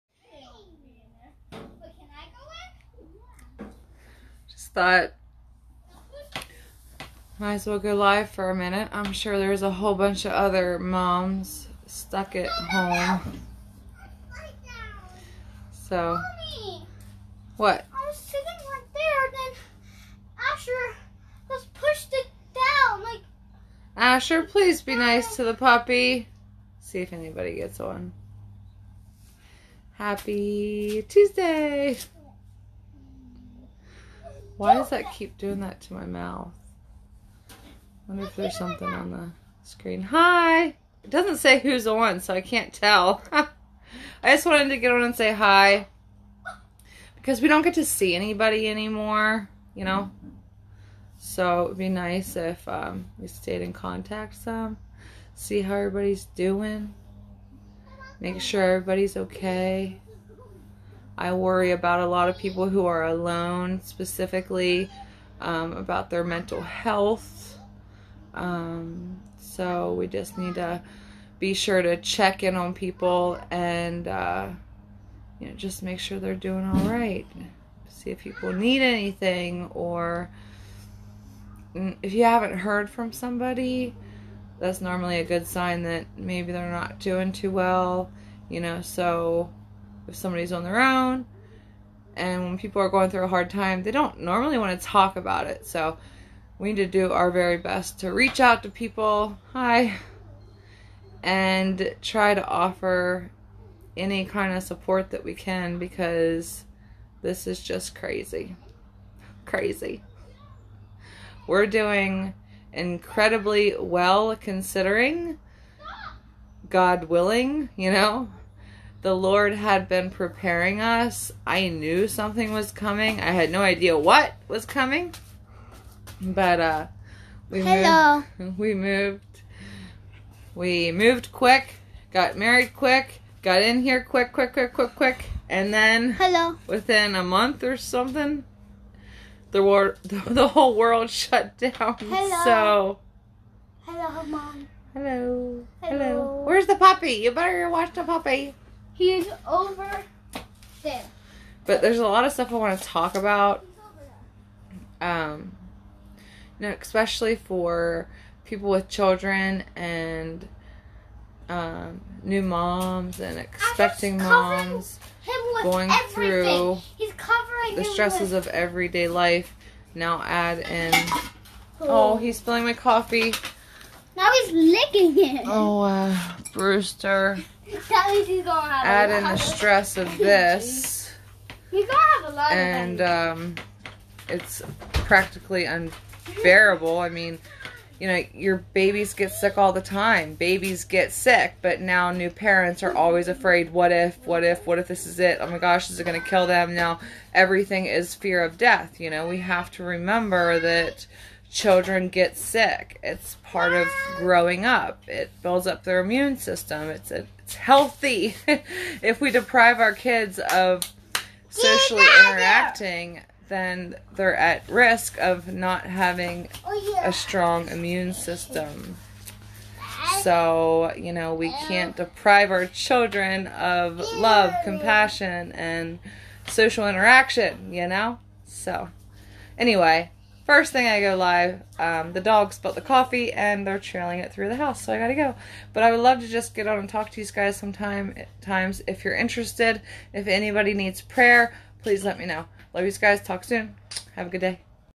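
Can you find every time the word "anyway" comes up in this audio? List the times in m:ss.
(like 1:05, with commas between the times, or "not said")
3:49.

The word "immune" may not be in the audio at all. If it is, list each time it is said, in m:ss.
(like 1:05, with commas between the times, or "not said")
3:25, 3:37.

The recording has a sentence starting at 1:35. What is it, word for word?
So we need to do our very best to reach out to people.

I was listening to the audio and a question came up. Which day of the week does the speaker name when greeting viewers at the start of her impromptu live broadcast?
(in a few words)
Tuesday.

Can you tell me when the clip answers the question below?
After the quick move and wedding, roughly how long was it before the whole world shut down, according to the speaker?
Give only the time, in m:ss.
2:17.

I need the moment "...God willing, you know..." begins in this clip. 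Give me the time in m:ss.
1:56.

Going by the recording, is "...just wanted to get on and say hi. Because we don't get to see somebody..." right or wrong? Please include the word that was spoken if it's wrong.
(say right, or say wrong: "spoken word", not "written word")
wrong: "anybody", not "somebody".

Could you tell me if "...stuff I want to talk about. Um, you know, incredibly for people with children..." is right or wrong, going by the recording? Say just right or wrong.
wrong.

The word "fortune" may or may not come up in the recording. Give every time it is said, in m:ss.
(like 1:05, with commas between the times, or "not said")
not said.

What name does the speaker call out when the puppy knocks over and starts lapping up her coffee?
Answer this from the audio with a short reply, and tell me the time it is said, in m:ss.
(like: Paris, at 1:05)
Brewster, at 2:56.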